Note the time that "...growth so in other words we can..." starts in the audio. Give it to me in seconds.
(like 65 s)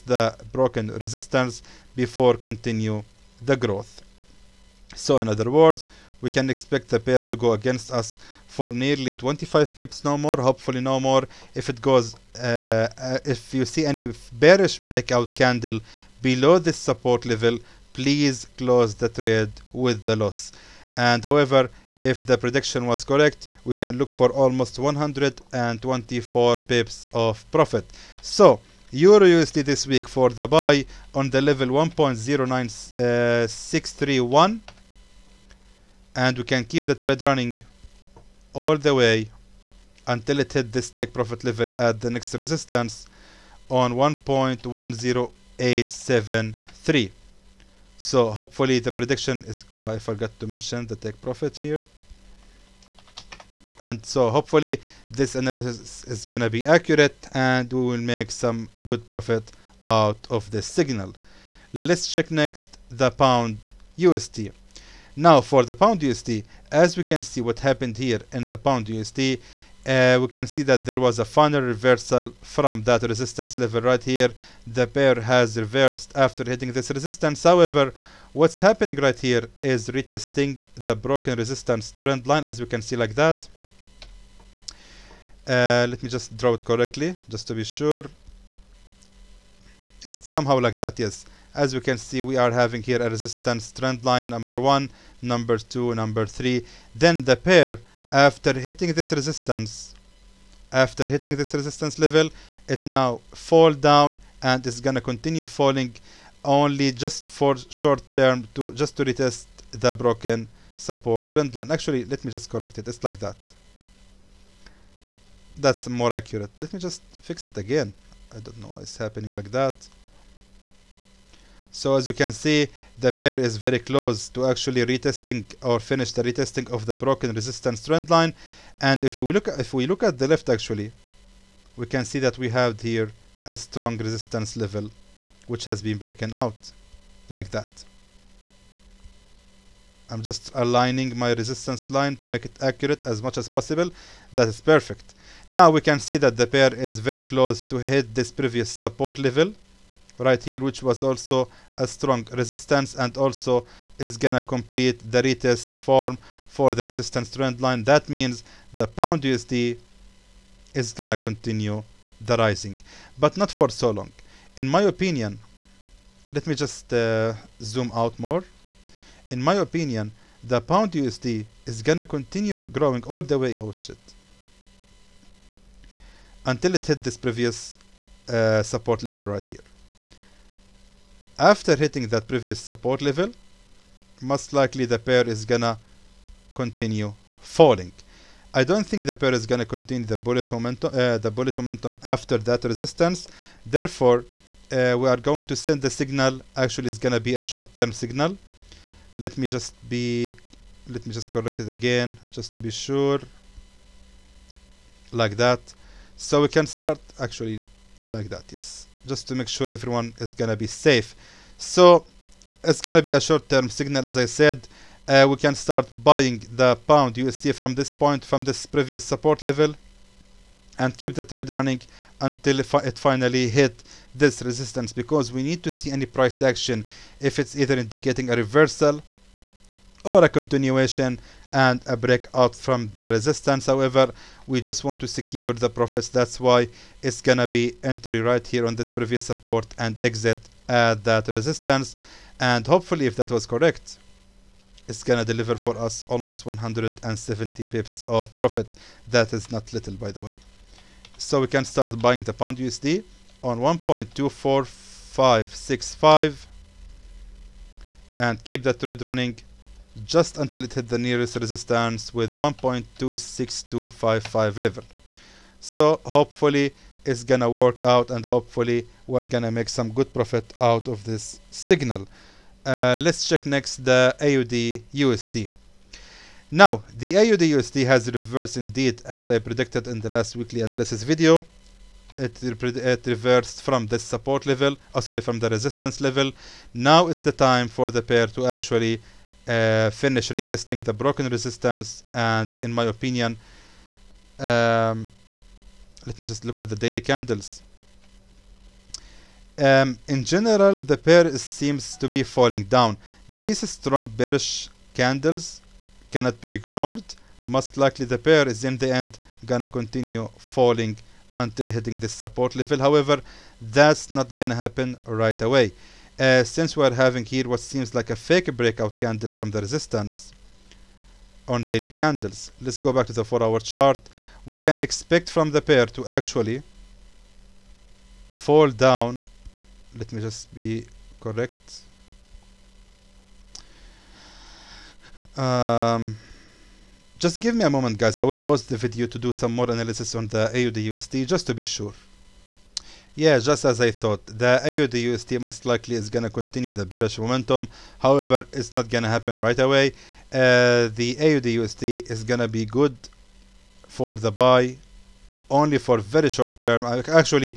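3 s.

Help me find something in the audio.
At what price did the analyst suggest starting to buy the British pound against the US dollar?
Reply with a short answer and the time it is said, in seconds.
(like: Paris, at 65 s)
1.24565, at 253 s.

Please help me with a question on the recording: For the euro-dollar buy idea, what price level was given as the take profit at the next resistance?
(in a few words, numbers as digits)
1.10873.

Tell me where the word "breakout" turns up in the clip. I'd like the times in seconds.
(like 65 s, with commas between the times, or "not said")
14 s, 231 s, 318 s.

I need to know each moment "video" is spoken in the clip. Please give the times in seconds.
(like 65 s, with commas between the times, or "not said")
281 s, 338 s.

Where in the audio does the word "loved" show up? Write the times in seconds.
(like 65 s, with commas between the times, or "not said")
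not said.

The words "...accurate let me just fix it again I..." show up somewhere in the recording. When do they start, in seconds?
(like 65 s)
116 s.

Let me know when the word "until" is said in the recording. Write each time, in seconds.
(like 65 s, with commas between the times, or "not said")
40 s, 176 s, 222 s, 260 s, 311 s.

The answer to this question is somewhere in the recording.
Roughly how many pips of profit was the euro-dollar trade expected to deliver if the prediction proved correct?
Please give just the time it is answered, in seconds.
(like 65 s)
24 s.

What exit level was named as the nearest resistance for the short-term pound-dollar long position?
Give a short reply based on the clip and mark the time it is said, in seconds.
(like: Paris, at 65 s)
1.26255, at 262 s.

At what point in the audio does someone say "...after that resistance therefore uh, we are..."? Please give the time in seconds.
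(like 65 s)
192 s.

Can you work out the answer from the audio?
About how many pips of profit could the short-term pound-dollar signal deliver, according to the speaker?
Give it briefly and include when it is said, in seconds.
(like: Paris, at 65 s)
170 pips, at 246 s.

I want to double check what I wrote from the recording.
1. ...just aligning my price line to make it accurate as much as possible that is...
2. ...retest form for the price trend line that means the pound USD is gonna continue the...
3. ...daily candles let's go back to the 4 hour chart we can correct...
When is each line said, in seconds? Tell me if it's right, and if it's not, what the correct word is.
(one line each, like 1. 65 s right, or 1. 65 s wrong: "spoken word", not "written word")
1. 140 s wrong: "resistance", not "price"
2. 155 s wrong: "resistance", not "price"
3. 321 s wrong: "expect", not "correct".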